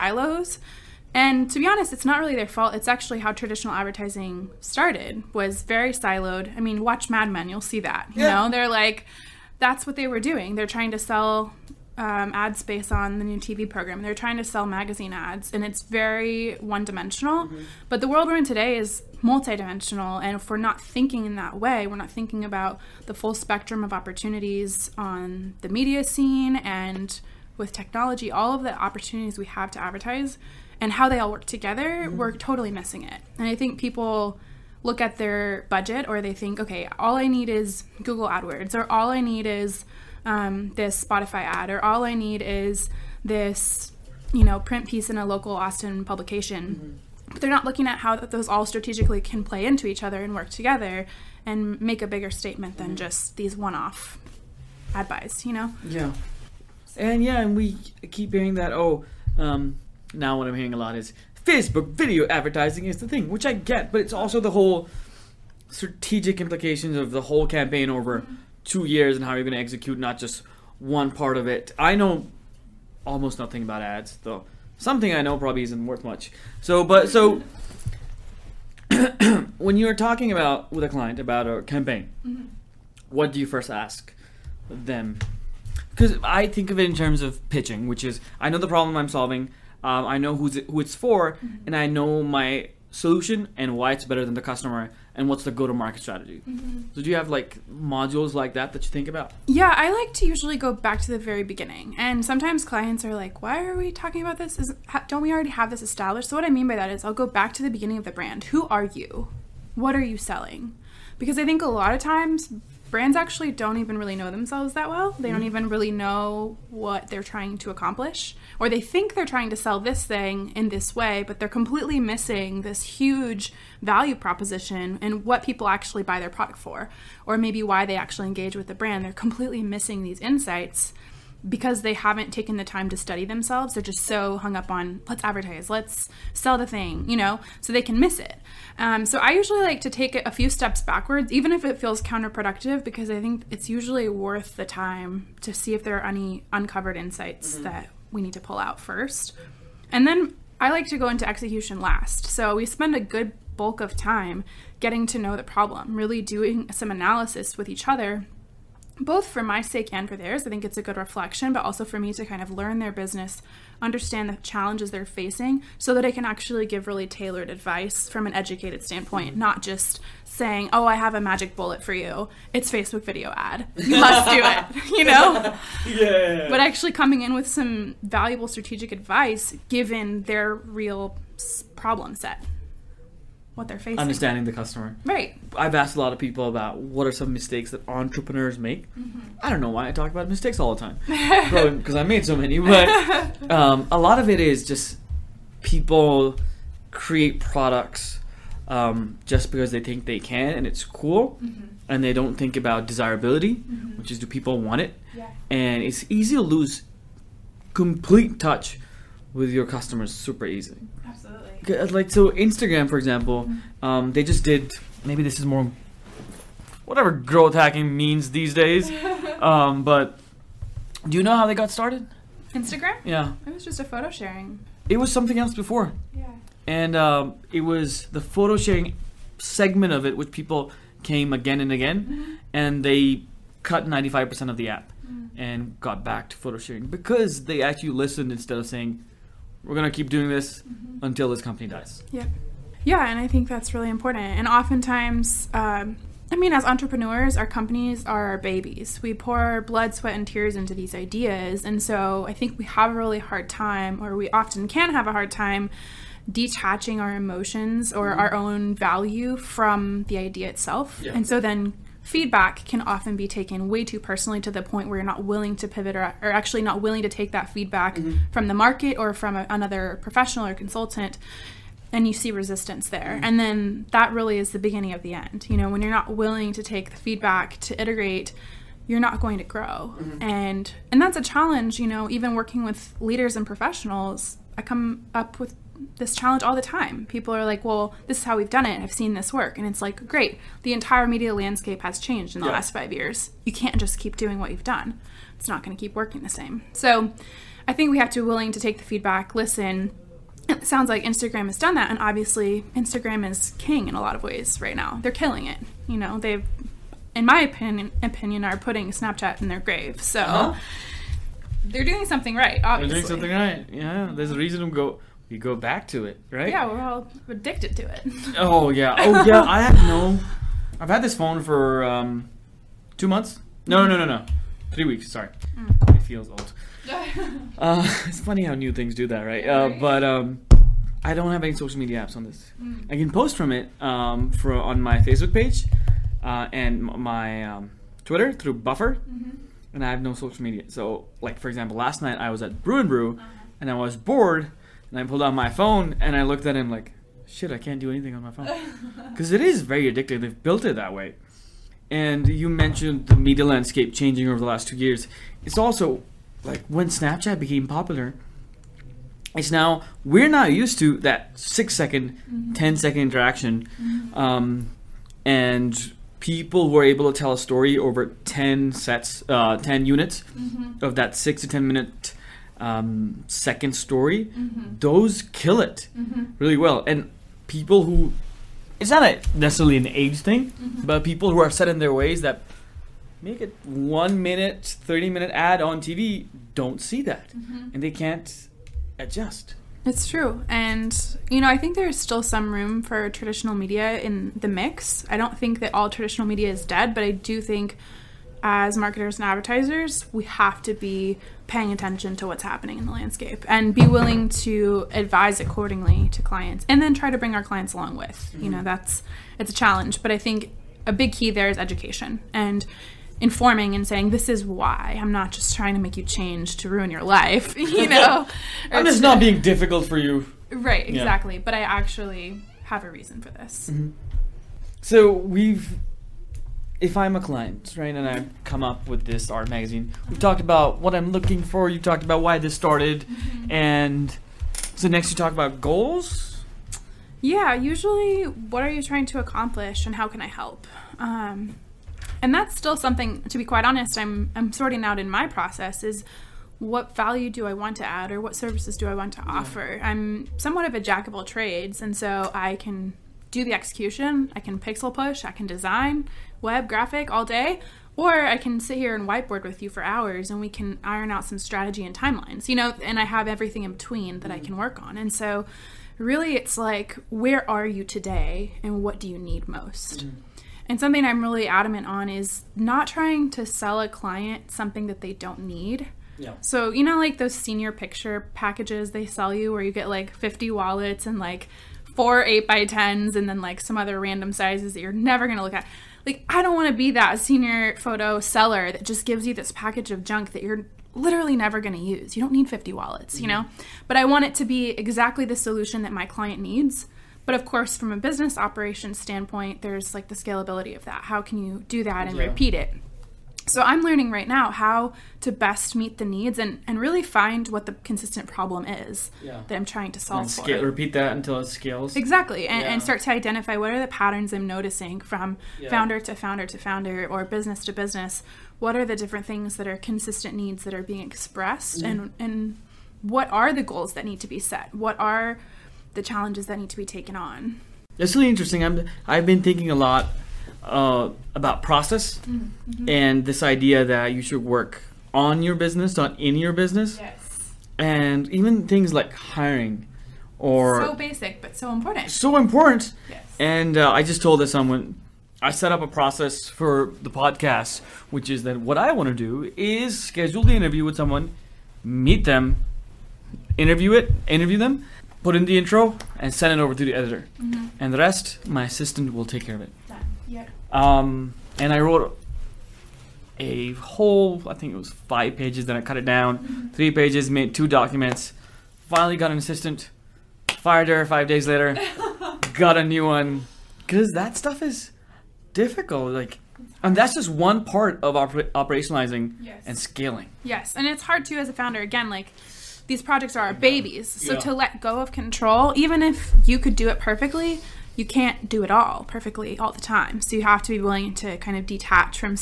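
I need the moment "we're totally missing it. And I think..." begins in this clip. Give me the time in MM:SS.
00:32.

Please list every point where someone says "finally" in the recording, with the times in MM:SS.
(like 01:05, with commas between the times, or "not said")
09:28.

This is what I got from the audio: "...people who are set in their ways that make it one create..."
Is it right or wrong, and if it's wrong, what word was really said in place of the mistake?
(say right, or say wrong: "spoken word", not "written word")
wrong: "minute", not "create".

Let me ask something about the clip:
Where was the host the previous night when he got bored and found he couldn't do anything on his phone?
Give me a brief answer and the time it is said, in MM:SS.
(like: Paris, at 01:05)
Brew and Brew, at 05:42.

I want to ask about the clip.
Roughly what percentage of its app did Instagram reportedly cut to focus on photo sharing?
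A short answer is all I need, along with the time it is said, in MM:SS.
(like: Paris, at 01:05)
95%, at 03:53.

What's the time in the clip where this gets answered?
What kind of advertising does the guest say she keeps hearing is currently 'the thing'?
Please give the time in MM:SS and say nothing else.
01:01.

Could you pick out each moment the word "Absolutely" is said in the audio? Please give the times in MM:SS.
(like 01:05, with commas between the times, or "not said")
03:31.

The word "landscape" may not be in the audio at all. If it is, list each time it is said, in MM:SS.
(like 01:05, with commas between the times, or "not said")
04:51, 05:53, 06:42.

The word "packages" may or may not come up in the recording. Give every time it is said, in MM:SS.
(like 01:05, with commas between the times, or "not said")
07:58, 08:09.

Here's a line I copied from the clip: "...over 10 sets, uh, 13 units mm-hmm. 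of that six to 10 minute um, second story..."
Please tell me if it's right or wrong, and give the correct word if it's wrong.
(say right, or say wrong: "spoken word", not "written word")
wrong: "10", not "13".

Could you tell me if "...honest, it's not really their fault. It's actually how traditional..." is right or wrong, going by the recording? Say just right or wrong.
right.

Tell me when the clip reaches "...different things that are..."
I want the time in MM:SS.
08:38.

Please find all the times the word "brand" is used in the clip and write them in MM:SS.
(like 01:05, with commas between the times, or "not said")
01:48, 01:52, 02:08.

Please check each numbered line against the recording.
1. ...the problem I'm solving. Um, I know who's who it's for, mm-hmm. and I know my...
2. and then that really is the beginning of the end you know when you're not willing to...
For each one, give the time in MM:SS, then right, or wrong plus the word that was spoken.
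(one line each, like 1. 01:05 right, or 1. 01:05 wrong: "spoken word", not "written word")
1. 01:28 right
2. 04:33 right.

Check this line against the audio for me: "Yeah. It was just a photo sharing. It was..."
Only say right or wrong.
right.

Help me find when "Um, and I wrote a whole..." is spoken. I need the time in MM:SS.
09:20.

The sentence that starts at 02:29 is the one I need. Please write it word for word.
And then I like to go into execution last.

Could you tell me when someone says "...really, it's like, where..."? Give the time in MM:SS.
07:45.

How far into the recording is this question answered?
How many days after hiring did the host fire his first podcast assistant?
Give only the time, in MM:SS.
09:31.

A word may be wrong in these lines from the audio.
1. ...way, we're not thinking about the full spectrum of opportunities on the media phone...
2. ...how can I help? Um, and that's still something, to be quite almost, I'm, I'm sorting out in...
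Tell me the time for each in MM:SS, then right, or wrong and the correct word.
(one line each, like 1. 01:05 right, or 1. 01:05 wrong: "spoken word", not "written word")
1. 00:21 wrong: "scene", not "phone"
2. 07:19 wrong: "honest", not "almost".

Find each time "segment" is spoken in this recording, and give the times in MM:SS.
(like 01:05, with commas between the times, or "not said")
03:49.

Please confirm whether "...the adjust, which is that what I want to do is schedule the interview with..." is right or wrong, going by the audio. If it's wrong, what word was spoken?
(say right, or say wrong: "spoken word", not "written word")
wrong: "podcast", not "adjust".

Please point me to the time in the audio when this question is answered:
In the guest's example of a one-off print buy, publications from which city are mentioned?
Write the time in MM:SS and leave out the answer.
00:45.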